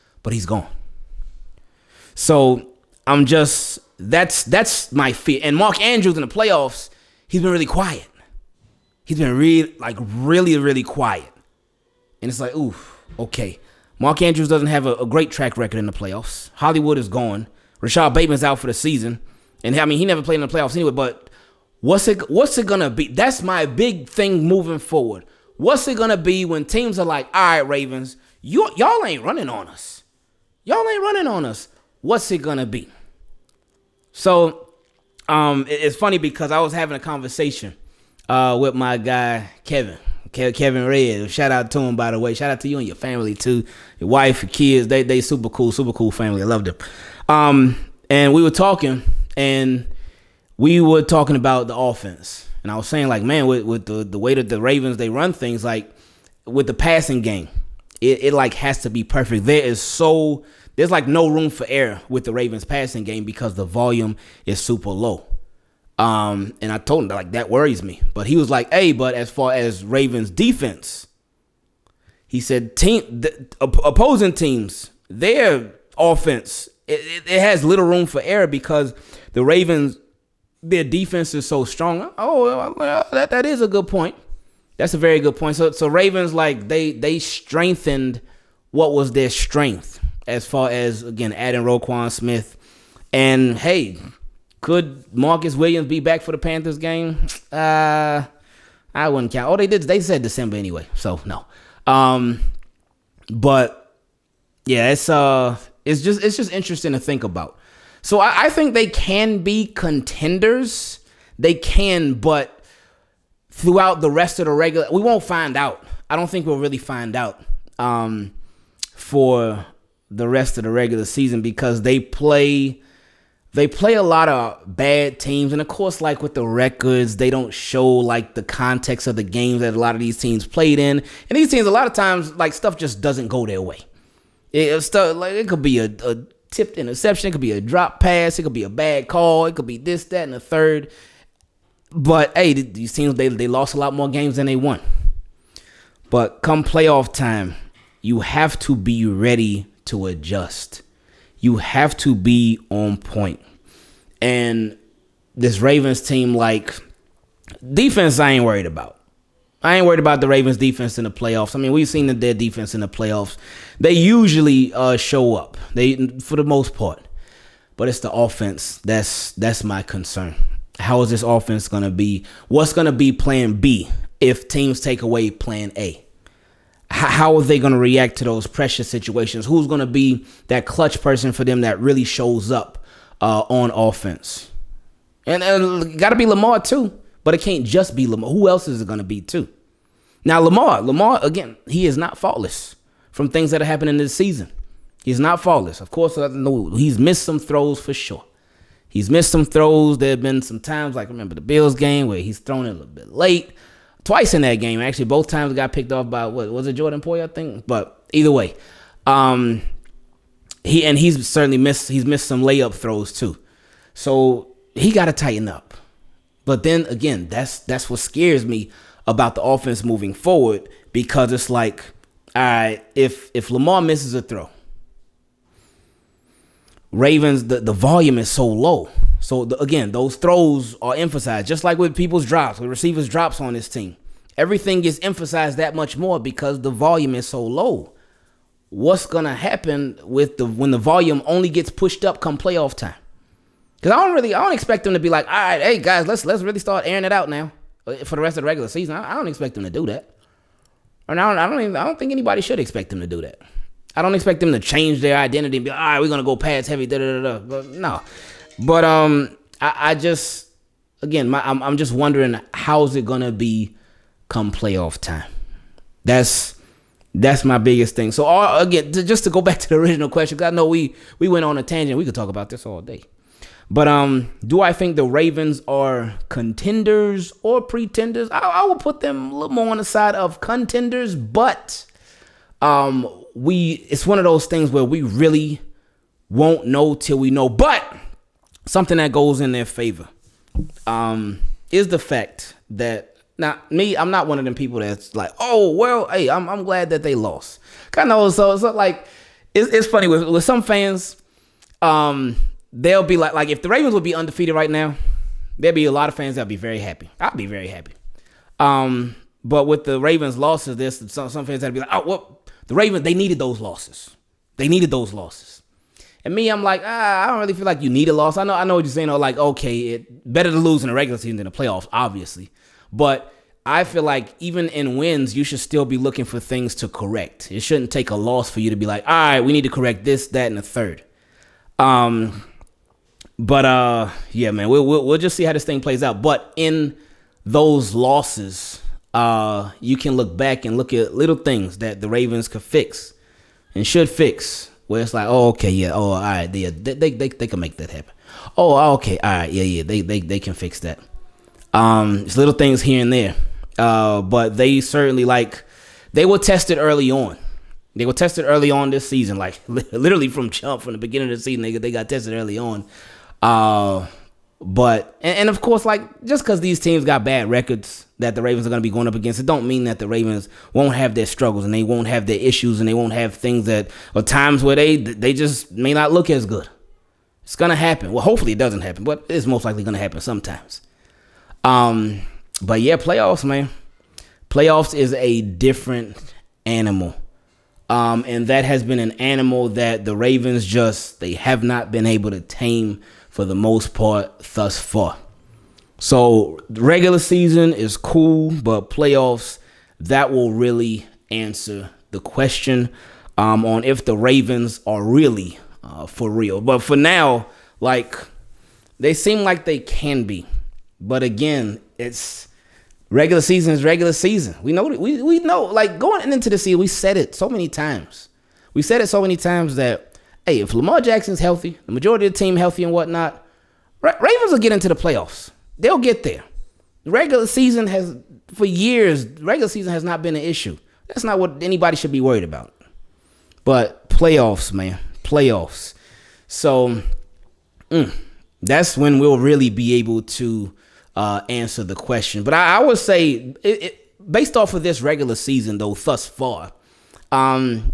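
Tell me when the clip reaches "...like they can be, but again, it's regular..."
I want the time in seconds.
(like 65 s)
409 s.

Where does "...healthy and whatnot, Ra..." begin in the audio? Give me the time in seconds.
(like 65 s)
422 s.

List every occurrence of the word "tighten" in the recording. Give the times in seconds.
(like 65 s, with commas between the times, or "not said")
215 s.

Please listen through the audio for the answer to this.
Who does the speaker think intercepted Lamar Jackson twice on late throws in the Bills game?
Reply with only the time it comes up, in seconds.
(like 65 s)
206 s.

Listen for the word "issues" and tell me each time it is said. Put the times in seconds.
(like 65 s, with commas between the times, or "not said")
372 s, 430 s.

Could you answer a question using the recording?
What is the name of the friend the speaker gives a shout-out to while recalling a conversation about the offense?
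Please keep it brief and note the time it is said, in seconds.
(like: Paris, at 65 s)
Kevin Red, at 40 s.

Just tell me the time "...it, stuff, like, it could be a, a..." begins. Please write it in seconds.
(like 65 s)
134 s.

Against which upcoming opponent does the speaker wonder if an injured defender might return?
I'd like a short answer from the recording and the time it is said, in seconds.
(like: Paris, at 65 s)
Panthers, at 96 s.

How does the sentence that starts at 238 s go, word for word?
What's gonna happen with the when the volume only gets pushed up come playoff time?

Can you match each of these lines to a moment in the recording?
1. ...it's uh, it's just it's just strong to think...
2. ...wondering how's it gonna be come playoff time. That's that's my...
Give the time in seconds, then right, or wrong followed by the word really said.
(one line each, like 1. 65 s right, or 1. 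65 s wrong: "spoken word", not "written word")
1. 104 s wrong: "interesting", not "strong"
2. 261 s right.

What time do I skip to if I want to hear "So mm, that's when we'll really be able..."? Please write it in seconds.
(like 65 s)
436 s.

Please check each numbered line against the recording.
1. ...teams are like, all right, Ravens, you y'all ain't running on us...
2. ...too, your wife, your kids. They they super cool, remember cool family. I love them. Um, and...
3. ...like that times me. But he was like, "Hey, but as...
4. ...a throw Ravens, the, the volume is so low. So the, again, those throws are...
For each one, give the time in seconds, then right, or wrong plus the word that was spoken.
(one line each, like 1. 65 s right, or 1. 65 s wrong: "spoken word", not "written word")
1. 26 s right
2. 43 s wrong: "super", not "remember"
3. 67 s wrong: "worries", not "times"
4. 224 s right.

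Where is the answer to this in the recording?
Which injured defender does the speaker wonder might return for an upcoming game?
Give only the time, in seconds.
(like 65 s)
95 s.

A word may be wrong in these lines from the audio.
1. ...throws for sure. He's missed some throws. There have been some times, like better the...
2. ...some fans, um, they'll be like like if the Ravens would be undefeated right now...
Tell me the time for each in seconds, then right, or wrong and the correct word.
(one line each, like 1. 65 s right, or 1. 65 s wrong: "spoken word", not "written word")
1. 197 s wrong: "remember", not "better"
2. 300 s right.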